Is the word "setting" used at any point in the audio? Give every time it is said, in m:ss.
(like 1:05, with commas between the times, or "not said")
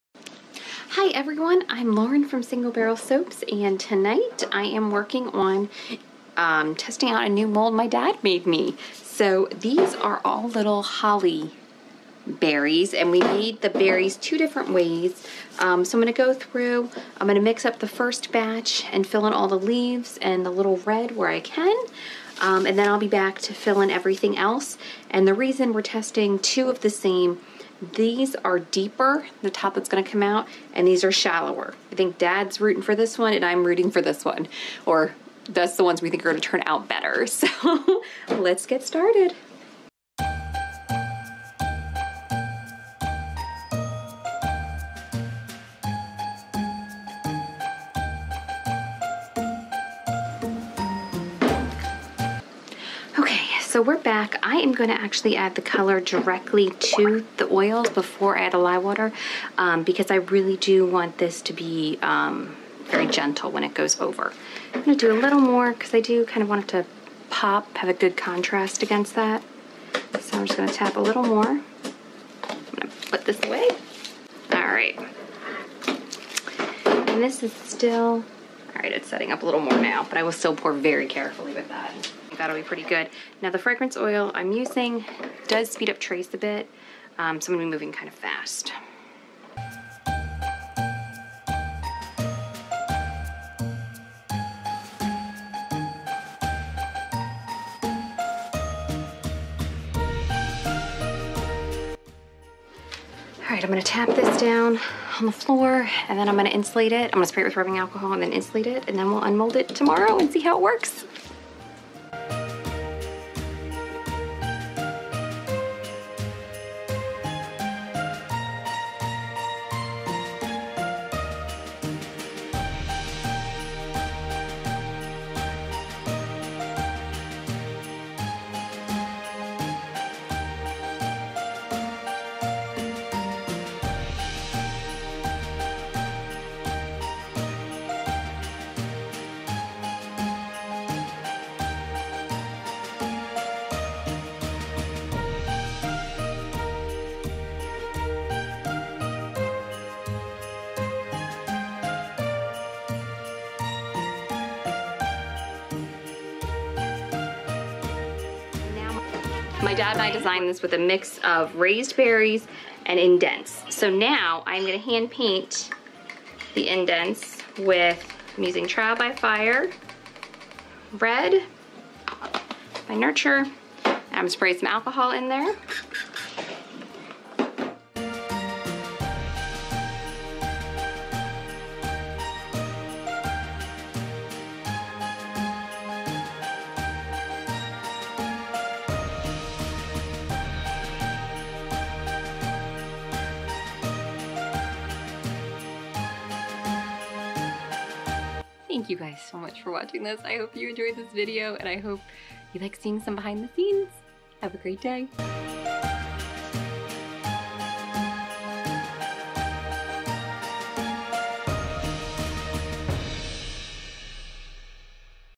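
1:19.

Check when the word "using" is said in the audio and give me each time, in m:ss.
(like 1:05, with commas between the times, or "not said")
1:24, 2:48.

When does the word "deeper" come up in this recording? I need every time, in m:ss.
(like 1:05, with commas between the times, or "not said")
0:28.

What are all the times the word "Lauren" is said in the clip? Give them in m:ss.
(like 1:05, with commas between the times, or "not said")
0:01.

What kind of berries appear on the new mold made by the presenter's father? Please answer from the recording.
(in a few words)
holly berries.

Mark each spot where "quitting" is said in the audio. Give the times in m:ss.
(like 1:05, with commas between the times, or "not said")
not said.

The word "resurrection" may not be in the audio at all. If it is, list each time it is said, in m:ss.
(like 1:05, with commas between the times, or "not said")
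not said.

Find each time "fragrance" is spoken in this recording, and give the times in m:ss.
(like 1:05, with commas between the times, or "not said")
1:23.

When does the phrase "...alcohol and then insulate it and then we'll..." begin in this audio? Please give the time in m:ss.
1:47.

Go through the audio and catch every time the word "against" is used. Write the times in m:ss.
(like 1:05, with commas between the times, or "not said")
1:08.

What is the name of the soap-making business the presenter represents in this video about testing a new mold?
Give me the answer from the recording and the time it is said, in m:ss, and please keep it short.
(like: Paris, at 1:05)
Single Barrel Soaps, at 0:02.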